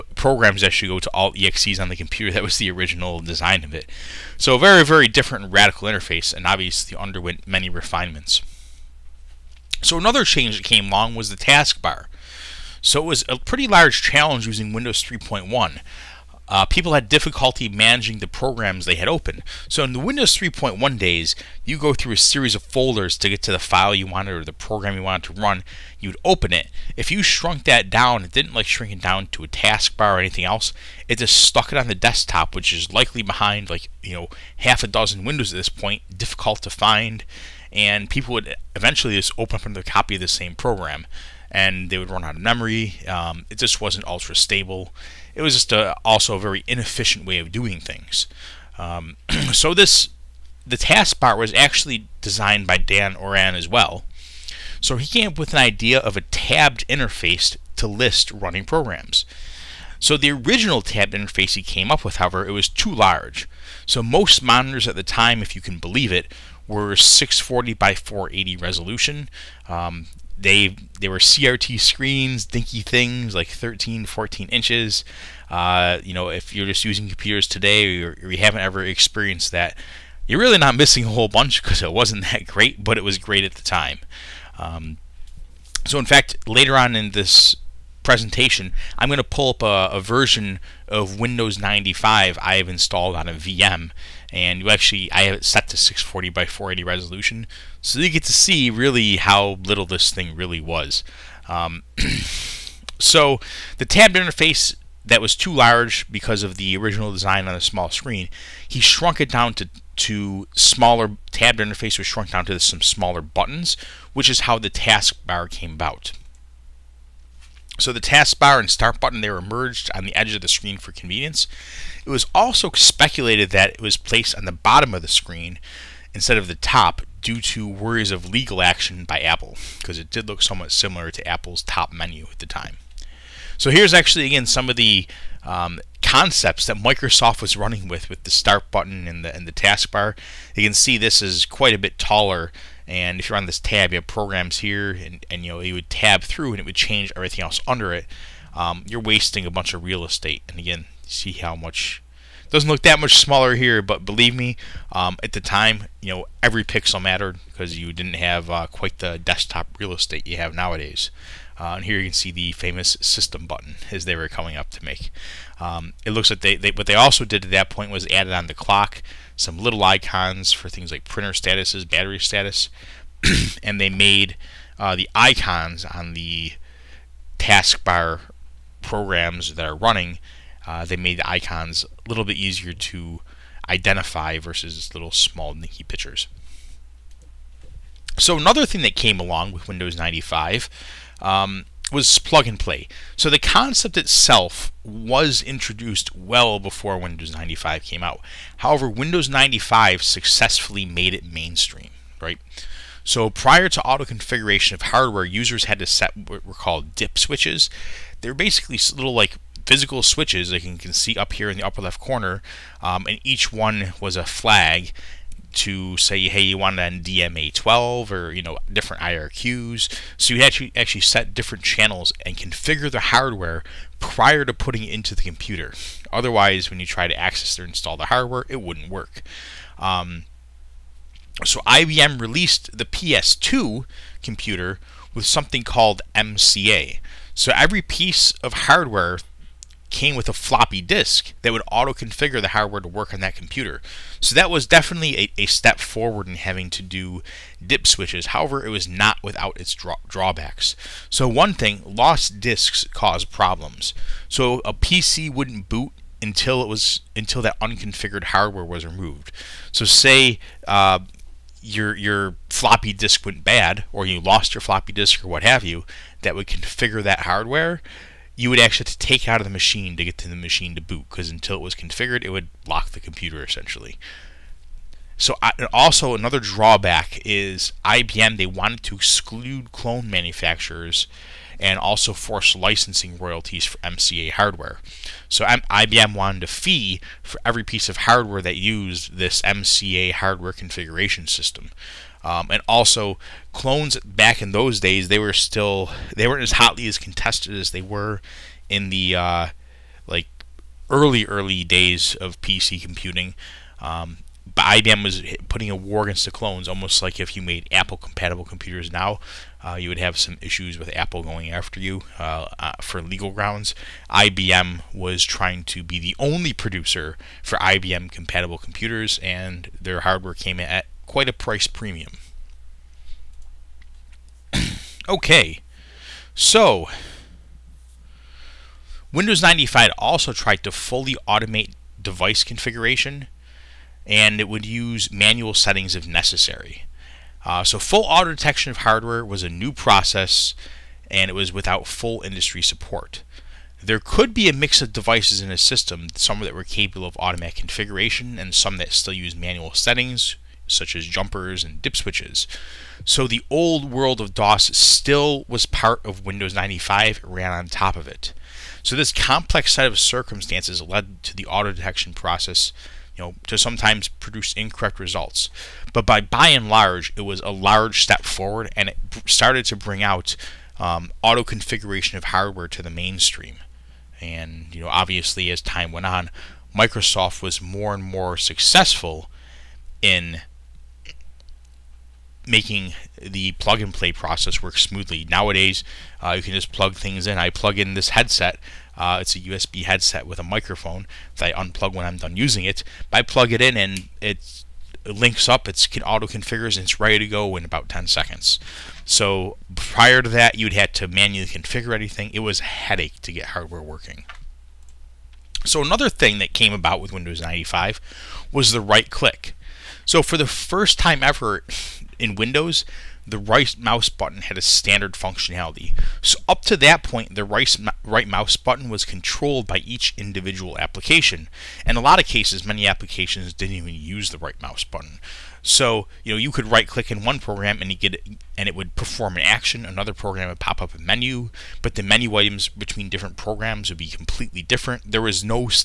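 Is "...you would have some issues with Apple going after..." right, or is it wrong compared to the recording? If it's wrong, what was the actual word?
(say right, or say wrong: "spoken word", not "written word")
right.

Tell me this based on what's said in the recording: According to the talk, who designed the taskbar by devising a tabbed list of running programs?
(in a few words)
Dan Oran.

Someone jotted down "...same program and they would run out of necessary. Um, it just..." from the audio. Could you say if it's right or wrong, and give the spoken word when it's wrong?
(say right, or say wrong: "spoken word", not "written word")
wrong: "memory", not "necessary".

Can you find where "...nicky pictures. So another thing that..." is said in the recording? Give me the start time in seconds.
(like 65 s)
185 s.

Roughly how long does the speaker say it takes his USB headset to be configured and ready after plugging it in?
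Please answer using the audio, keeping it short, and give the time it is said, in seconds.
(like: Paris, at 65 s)
10 seconds, at 397 s.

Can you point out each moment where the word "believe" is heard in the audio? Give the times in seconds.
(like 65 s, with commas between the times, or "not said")
65 s, 154 s.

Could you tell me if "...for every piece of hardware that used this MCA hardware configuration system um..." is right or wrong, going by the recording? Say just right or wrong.
right.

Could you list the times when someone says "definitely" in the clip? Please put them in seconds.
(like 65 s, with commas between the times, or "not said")
244 s.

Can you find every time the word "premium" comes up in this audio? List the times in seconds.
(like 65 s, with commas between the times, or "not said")
321 s.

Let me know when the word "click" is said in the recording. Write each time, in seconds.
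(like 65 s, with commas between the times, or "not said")
409 s, 426 s.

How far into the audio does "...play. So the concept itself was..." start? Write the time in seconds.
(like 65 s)
192 s.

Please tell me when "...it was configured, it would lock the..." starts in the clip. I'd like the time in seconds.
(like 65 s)
271 s.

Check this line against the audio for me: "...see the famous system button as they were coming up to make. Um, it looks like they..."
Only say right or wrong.
right.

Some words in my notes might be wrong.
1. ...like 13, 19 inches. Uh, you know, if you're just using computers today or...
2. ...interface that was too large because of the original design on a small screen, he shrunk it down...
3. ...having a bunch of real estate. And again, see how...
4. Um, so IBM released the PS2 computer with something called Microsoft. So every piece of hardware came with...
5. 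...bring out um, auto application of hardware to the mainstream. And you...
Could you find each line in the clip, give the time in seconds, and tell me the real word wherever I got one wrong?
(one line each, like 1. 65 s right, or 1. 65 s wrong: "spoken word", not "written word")
1. 73 s wrong: "14", not "19"
2. 104 s right
3. 148 s wrong: "wasting", not "having"
4. 229 s wrong: "MCA", not "Microsoft"
5. 369 s wrong: "configuration", not "application".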